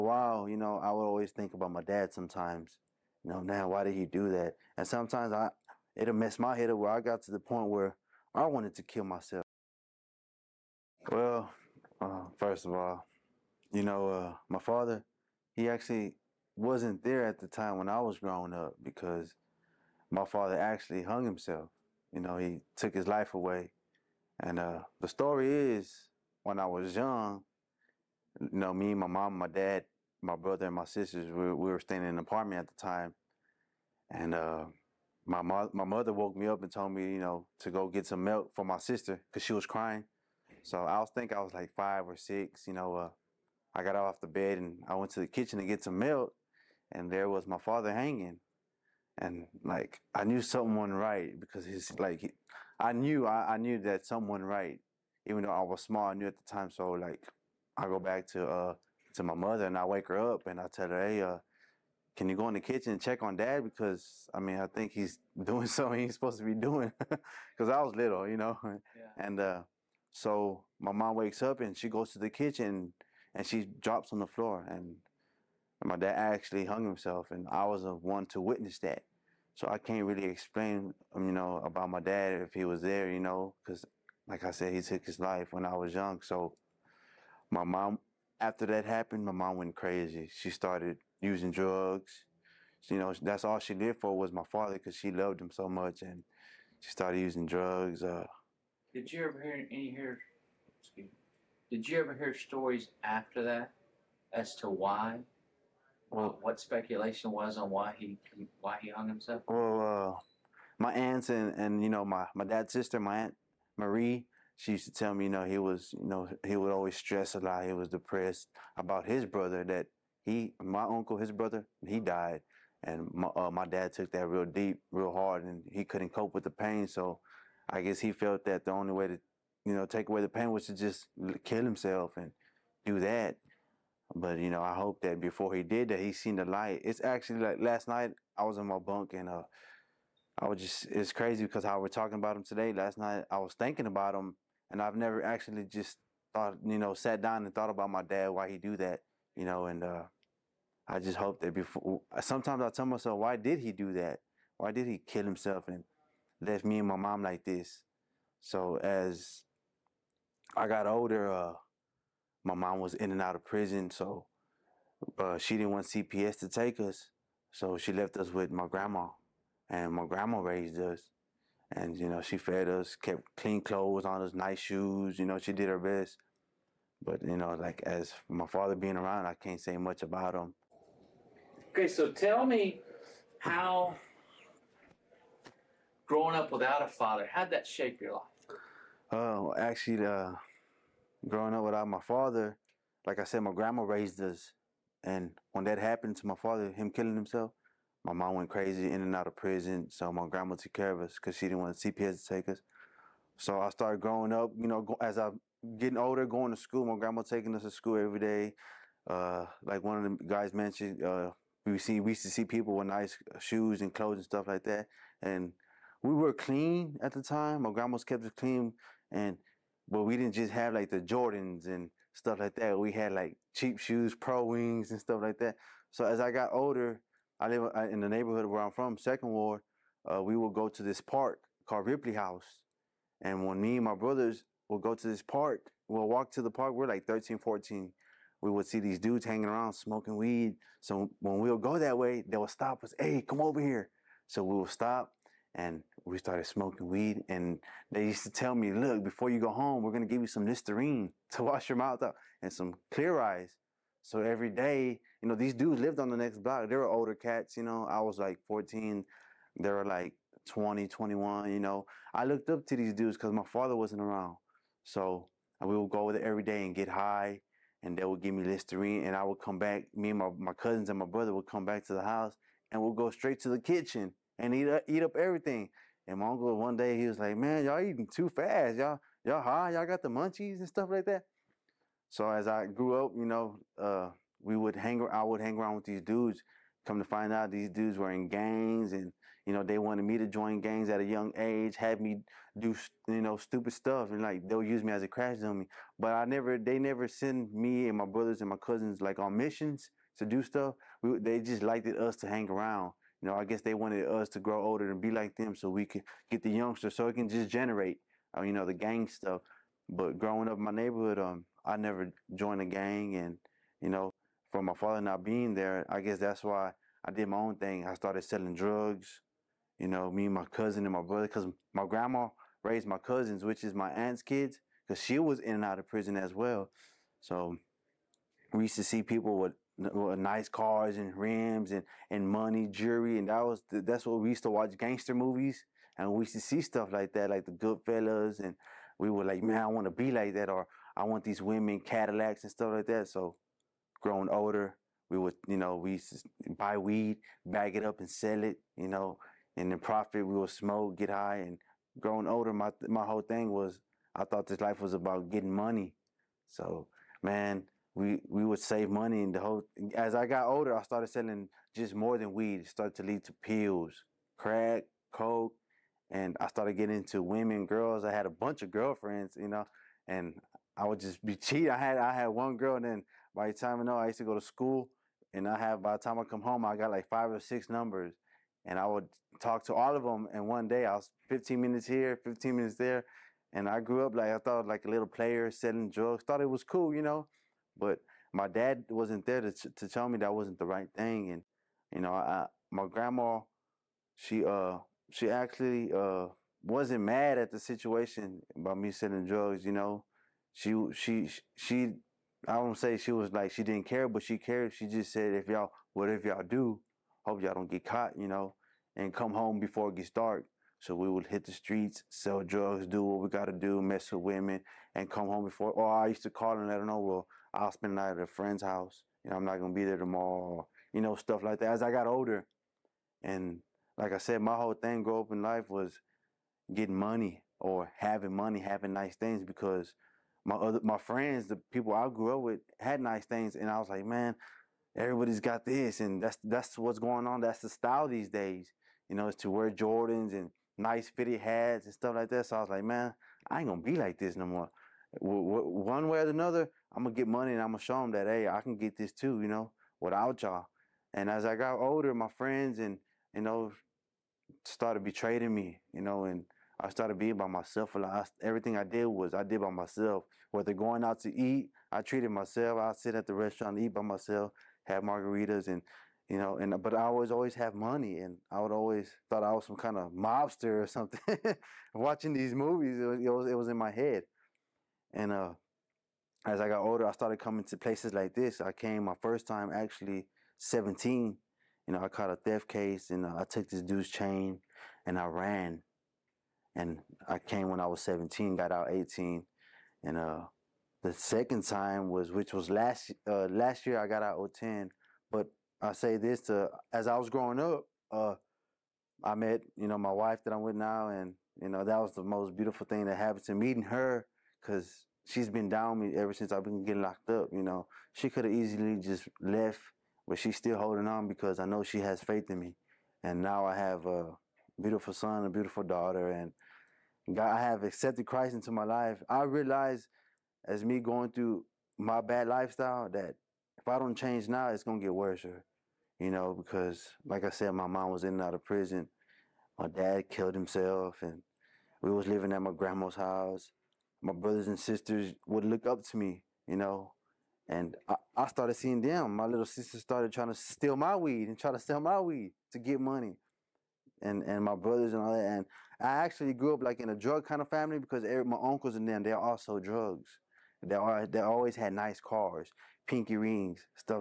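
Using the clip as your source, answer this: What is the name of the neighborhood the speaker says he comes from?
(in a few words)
Second Ward.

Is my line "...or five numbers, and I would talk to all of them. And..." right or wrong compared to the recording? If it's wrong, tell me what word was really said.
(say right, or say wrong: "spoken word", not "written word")
wrong: "six", not "five".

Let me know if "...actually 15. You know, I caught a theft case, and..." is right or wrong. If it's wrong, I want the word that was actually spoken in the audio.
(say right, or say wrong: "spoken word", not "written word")
wrong: "17", not "15".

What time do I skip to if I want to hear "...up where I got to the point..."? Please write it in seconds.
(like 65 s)
6 s.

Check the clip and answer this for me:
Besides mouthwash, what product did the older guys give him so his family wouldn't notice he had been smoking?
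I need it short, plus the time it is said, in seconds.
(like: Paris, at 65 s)
Clear Eyes, at 252 s.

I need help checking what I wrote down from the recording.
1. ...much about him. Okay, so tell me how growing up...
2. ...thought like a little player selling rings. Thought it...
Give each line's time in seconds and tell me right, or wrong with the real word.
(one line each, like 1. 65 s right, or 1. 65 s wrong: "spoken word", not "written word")
1. 179 s right
2. 384 s wrong: "drugs", not "rings".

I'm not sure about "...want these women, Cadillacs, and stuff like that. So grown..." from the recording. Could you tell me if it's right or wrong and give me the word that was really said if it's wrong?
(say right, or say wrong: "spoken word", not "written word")
right.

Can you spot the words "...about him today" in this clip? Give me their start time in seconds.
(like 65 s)
142 s.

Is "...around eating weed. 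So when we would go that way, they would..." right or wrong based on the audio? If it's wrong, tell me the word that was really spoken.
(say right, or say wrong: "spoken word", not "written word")
wrong: "smoking", not "eating".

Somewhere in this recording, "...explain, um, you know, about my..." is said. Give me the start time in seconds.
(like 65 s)
80 s.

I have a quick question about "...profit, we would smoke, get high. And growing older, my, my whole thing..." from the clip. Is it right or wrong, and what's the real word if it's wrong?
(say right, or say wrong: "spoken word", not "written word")
right.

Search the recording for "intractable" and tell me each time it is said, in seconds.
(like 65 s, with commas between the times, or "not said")
not said.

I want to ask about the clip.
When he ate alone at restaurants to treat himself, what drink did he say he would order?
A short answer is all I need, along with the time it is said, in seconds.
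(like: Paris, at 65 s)
Margaritas, at 465 s.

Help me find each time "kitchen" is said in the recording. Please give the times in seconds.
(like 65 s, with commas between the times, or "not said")
45 s, 62 s, 72 s, 273 s.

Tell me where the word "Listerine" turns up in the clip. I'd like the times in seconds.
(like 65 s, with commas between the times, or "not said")
250 s, 268 s.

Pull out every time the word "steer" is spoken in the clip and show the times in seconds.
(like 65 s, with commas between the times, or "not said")
not said.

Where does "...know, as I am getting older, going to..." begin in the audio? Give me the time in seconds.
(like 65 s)
204 s.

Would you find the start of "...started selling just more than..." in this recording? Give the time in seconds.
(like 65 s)
360 s.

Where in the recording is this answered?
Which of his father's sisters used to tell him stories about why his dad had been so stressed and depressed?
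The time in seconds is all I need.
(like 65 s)
113 s.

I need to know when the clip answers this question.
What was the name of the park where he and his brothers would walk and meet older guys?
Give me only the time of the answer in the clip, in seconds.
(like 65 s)
231 s.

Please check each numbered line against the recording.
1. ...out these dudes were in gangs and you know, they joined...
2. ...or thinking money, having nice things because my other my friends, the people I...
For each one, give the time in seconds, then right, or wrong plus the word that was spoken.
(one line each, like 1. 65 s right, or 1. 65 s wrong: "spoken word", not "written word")
1. 287 s wrong: "wanted", not "joined"
2. 427 s wrong: "having", not "thinking".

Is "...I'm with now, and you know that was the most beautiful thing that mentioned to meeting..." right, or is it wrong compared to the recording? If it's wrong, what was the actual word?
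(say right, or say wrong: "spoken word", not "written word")
wrong: "happened", not "mentioned".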